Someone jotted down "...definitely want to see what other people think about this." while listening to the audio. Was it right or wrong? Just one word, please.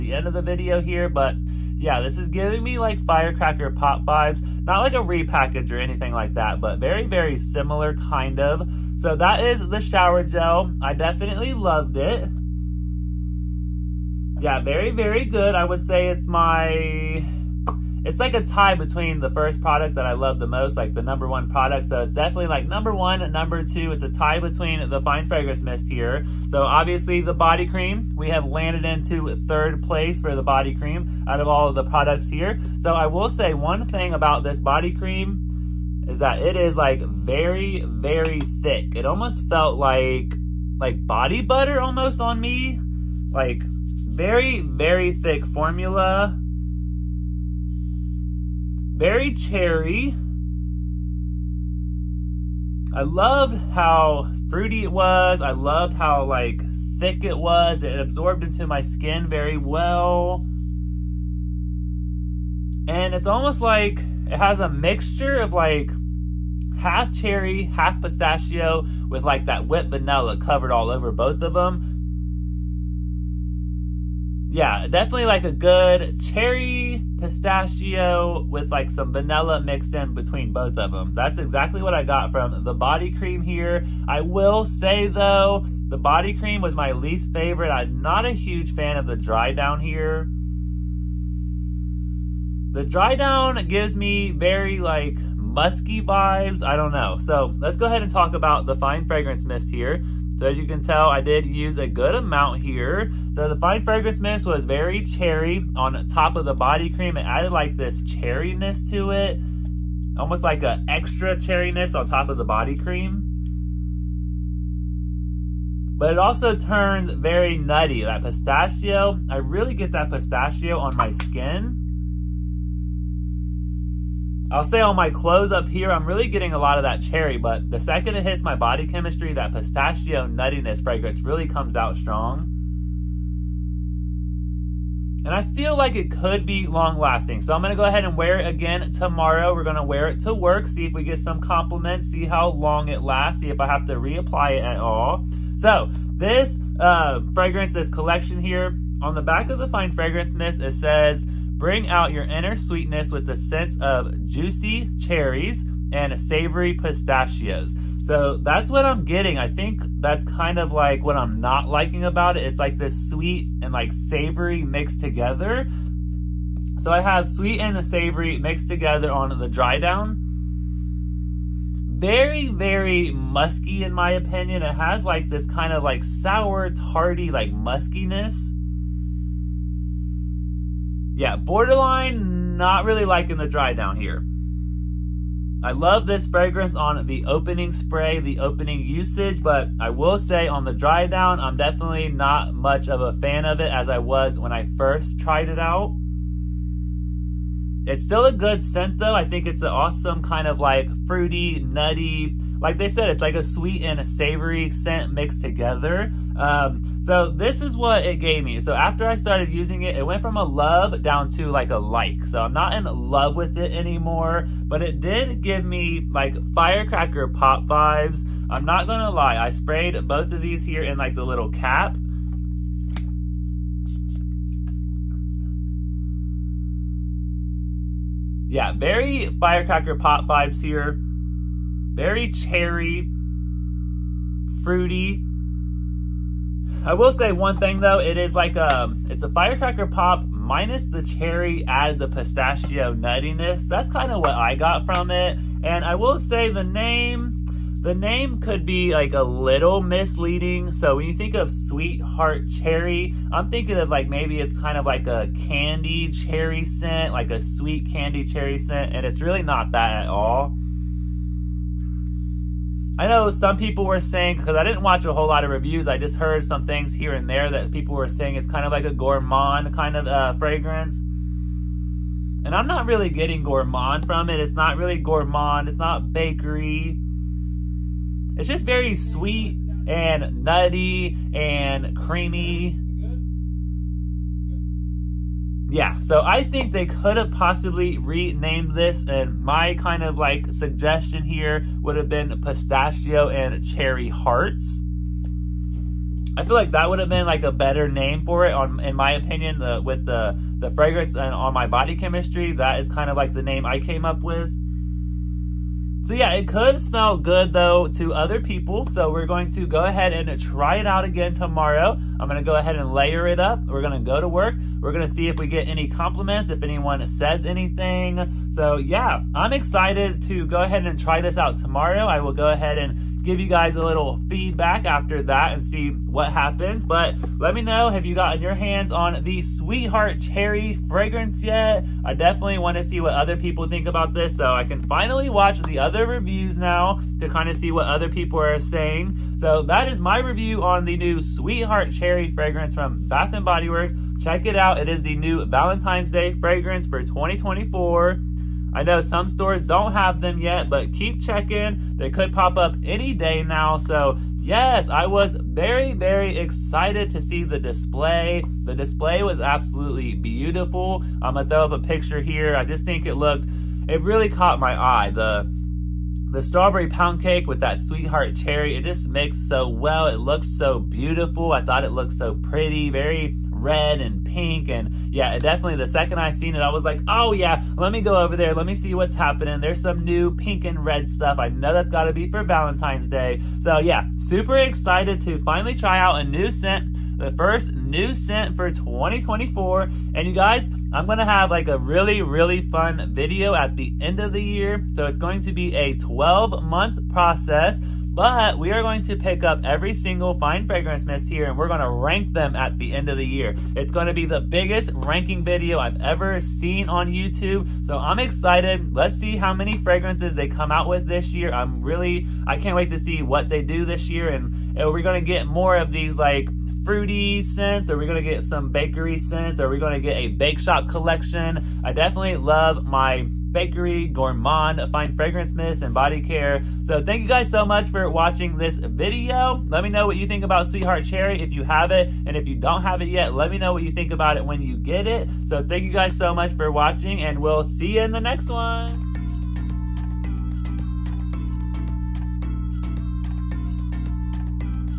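right.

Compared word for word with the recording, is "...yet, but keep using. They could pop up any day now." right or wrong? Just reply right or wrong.
wrong.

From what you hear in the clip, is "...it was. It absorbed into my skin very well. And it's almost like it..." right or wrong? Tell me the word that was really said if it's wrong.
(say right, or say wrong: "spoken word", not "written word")
right.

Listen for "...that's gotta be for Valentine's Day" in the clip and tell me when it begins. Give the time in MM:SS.
06:21.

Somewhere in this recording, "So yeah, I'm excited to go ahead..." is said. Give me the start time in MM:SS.
05:18.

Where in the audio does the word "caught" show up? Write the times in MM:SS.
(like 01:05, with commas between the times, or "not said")
06:04.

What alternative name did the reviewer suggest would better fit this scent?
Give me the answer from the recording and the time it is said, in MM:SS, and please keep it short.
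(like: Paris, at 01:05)
Pistachio and Cherry Hearts, at 04:52.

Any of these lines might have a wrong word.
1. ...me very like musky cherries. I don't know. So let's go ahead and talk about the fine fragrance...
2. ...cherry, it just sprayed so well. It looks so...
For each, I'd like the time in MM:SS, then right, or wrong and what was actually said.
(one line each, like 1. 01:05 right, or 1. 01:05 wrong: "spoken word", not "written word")
1. 01:33 wrong: "vibes", not "cherries"
2. 06:08 wrong: "mixed", not "sprayed".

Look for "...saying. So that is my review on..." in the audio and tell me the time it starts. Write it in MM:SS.
05:38.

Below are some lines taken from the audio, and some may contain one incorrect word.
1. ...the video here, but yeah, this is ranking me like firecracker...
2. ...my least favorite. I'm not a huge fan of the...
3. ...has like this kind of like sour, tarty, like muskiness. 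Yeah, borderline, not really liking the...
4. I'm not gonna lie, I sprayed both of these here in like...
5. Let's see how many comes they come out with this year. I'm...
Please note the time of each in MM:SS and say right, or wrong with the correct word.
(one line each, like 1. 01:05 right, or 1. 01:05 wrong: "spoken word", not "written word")
1. 00:00 wrong: "giving", not "ranking"
2. 01:26 right
3. 02:54 right
4. 03:38 right
5. 06:48 wrong: "fragrances", not "comes".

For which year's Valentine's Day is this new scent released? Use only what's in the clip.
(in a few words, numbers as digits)
2024.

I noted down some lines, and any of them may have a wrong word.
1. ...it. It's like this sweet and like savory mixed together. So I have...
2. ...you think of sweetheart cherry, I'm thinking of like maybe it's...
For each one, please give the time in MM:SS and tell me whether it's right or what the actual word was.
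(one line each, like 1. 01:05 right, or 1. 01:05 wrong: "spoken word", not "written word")
1. 02:42 right
2. 04:11 right.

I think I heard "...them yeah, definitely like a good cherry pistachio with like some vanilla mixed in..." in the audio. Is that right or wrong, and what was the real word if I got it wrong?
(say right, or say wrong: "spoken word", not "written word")
right.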